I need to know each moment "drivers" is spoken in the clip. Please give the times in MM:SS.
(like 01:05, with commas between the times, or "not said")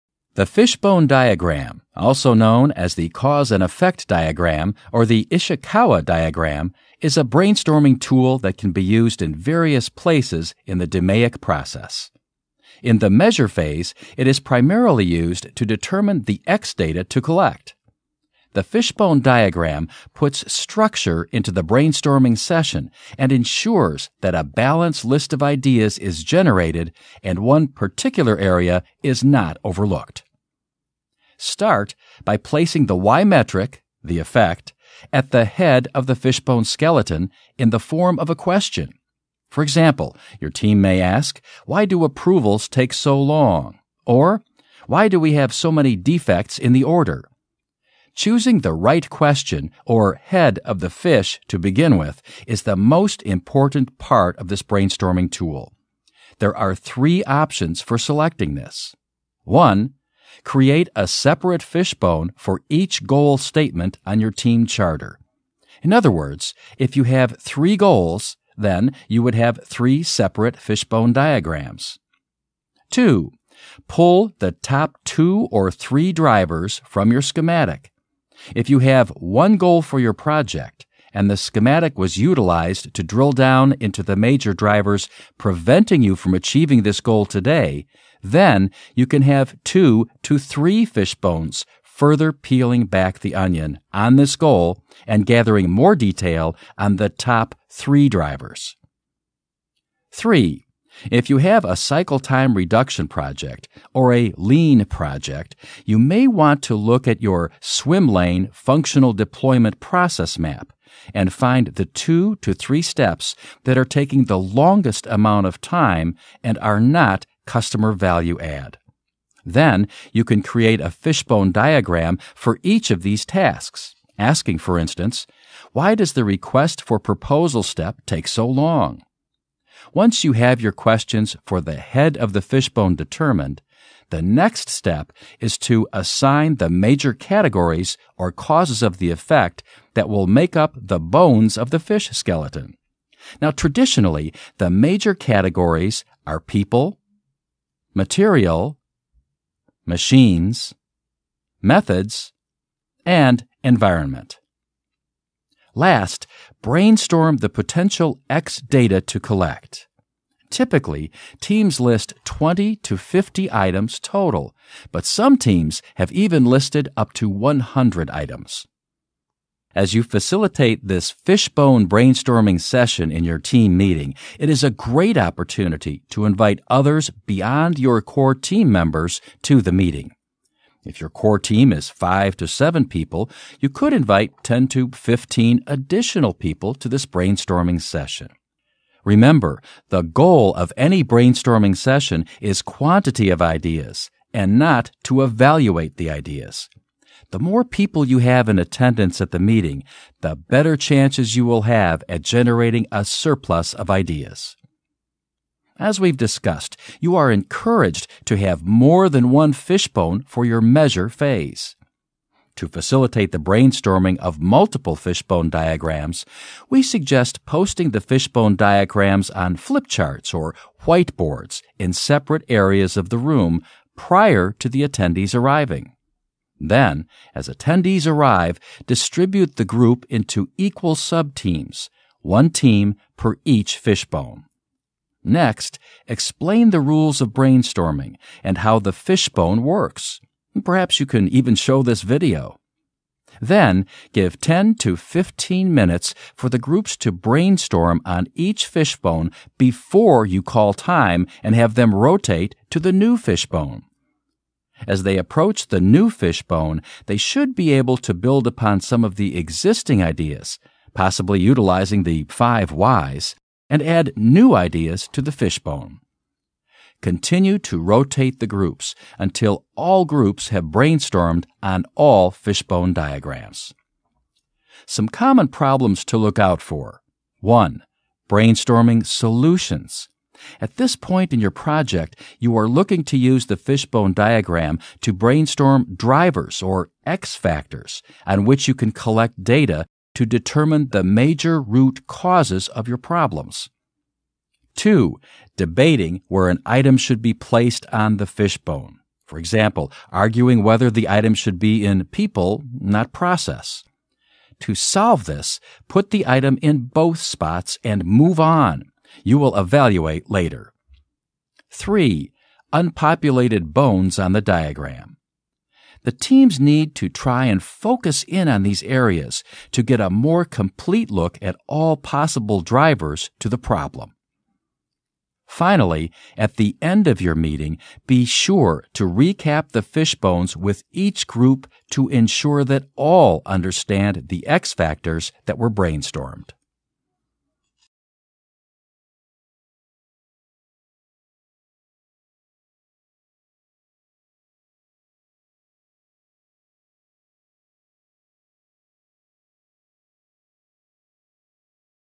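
01:16, 01:24, 01:38, 04:45, 05:22.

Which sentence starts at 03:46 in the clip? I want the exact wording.
Then, as attendees arrive, distribute the group into equal subteams, one team per each fishbone.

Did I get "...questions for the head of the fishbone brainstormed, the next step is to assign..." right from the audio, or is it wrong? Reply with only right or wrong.
wrong.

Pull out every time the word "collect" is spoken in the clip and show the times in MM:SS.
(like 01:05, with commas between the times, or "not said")
00:17, 02:39, 04:48.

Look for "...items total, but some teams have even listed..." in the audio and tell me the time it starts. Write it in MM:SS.
02:43.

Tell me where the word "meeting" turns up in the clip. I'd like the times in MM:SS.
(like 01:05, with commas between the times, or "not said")
02:53, 02:59, 03:19, 05:27.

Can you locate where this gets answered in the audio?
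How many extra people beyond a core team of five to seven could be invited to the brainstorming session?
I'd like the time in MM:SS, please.
03:04.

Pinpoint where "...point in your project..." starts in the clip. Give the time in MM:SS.
04:40.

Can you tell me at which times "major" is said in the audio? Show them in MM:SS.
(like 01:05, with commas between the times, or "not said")
01:24, 02:16, 02:24, 04:51.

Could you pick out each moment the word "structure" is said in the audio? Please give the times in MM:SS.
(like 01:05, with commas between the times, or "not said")
00:20.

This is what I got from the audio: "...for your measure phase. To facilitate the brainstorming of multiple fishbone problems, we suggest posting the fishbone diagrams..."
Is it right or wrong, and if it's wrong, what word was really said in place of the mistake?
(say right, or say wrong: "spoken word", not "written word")
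wrong: "diagrams", not "problems".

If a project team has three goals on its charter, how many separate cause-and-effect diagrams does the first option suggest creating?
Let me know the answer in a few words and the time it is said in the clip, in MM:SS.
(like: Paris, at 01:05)
3, at 01:09.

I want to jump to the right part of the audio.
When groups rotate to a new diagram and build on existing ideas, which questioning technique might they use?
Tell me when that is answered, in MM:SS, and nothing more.
04:22.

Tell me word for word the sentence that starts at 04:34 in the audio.
Some common problems to look out for.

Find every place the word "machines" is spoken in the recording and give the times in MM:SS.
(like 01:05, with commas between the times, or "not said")
02:29.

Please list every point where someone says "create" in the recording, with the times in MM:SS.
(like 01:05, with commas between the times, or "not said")
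01:00, 02:00.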